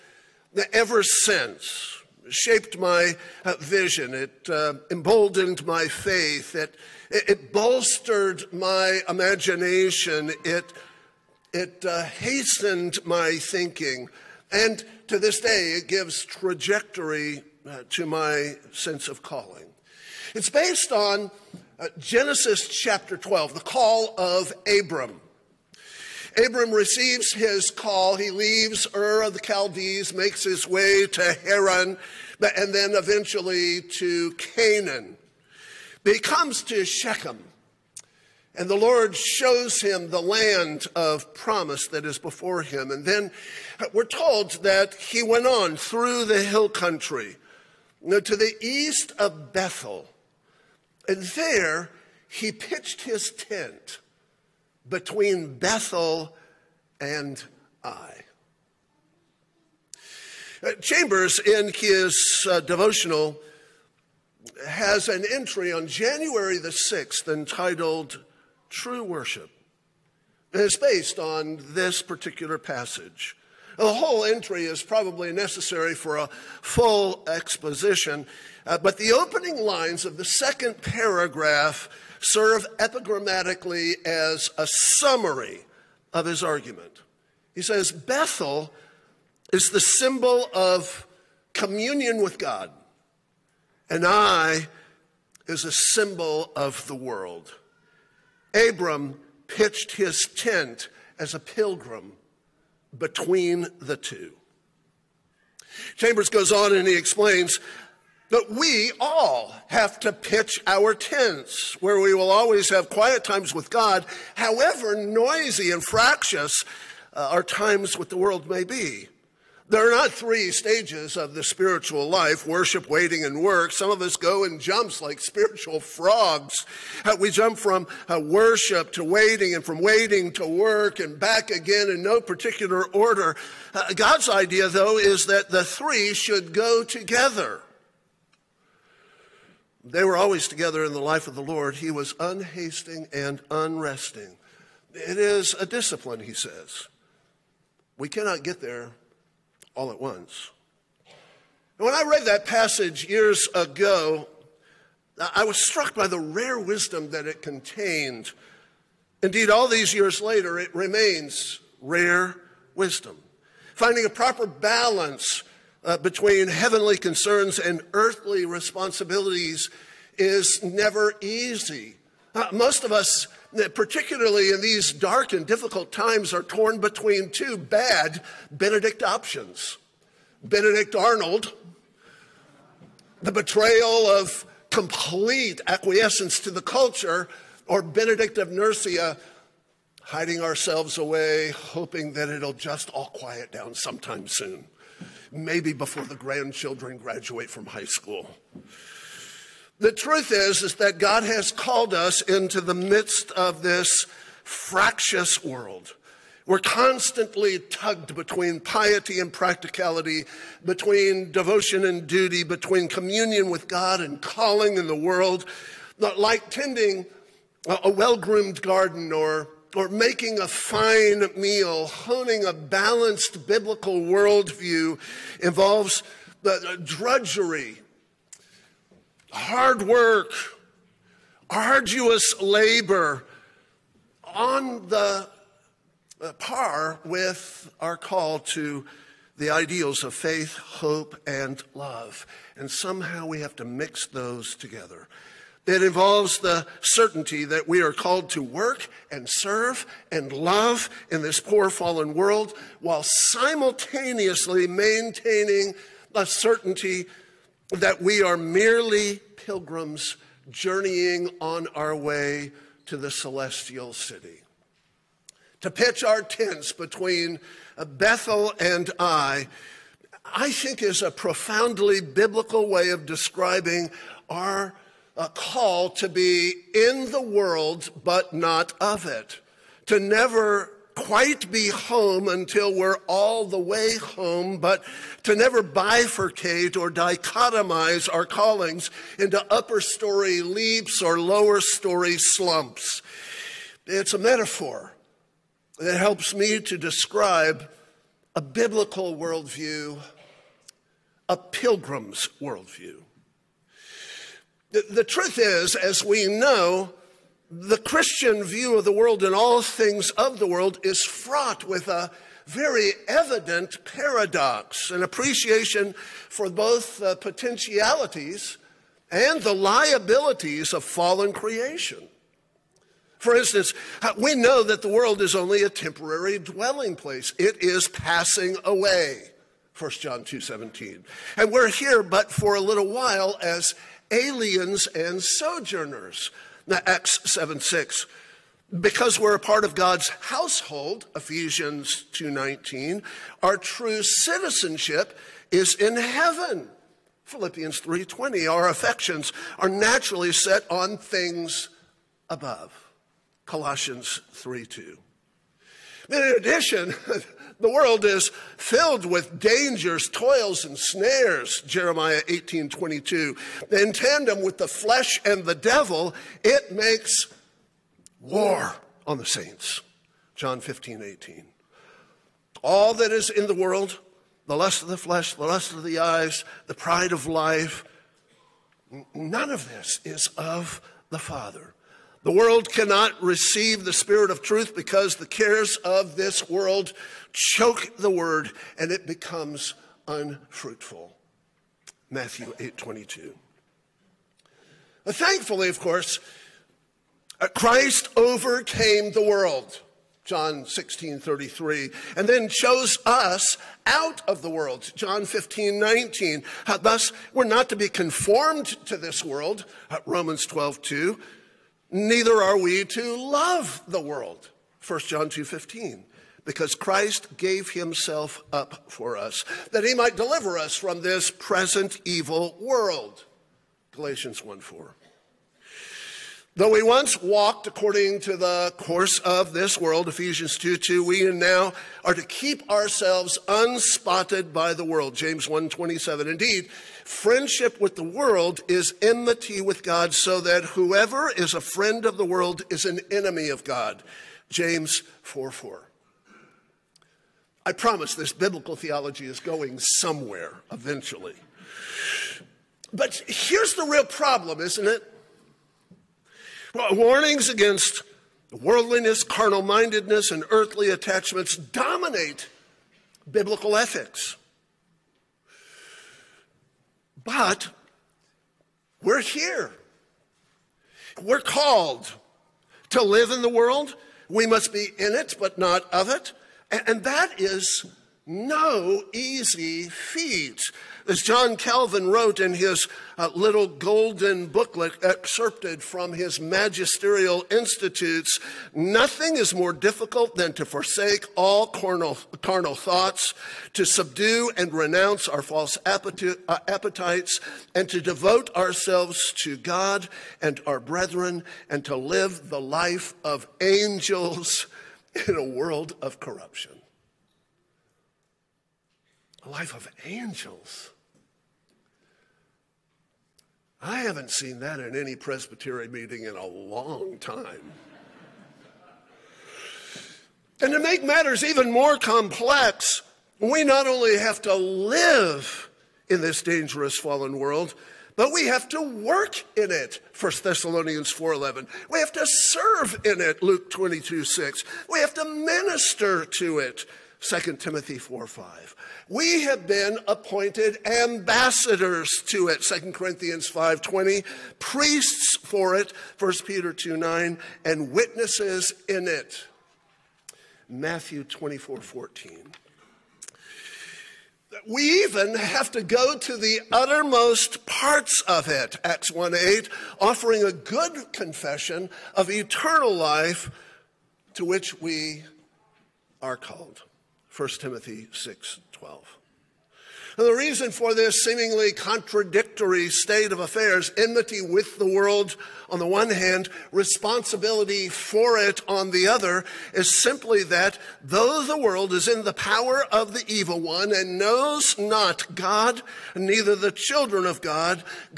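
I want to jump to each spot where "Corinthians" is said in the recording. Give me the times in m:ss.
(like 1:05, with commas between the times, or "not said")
9:02.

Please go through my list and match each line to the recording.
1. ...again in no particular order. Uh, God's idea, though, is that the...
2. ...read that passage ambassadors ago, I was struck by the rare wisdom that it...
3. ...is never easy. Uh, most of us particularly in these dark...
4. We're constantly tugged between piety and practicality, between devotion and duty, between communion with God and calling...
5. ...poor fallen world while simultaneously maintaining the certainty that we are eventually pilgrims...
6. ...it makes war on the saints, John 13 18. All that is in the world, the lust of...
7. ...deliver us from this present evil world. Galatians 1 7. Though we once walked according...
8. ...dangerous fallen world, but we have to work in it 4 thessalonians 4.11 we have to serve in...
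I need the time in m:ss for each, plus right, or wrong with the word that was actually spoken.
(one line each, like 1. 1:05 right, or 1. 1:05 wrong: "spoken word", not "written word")
1. 2:11 right
2. 2:32 wrong: "years", not "ambassadors"
3. 2:50 right
4. 3:26 right
5. 4:11 wrong: "merely", not "eventually"
6. 6:06 wrong: "15", not "13"
7. 7:00 wrong: "4", not "7"
8. 8:46 wrong: "1", not "4".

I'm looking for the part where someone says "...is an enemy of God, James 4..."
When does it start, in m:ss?
7:22.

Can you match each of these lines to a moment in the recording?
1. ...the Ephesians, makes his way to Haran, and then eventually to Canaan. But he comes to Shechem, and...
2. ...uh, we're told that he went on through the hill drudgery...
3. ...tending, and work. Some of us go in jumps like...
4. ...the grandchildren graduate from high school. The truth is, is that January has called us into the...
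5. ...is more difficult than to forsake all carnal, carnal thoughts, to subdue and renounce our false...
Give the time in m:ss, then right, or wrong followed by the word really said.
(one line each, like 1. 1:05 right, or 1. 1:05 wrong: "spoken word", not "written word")
1. 0:29 wrong: "Chaldees", not "Ephesians"
2. 0:43 wrong: "country", not "drudgery"
3. 2:02 wrong: "waiting", not "tending"
4. 3:16 wrong: "God", not "January"
5. 8:09 right.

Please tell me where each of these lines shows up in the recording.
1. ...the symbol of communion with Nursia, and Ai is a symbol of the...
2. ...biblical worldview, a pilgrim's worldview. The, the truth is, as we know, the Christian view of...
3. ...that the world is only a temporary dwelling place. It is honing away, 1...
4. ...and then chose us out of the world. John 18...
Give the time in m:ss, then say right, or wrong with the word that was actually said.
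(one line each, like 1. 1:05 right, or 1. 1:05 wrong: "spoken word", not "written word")
1. 1:29 wrong: "God", not "Nursia"
2. 4:58 right
3. 5:24 wrong: "passing", not "honing"
4. 6:42 wrong: "15", not "18".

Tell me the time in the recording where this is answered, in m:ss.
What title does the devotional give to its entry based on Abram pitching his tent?
1:08.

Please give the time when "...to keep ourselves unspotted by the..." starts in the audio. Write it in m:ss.
7:12.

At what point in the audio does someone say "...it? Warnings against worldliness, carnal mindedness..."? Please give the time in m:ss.
7:34.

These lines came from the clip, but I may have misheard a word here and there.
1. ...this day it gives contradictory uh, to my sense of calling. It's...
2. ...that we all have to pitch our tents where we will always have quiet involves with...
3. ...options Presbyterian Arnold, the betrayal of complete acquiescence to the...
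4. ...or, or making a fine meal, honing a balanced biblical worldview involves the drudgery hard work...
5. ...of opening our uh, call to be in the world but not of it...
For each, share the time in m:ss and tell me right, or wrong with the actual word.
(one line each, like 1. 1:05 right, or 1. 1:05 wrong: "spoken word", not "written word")
1. 0:15 wrong: "trajectory", not "contradictory"
2. 1:48 wrong: "times", not "involves"
3. 2:59 wrong: "Benedict", not "Presbyterian"
4. 3:39 right
5. 4:32 wrong: "describing", not "opening".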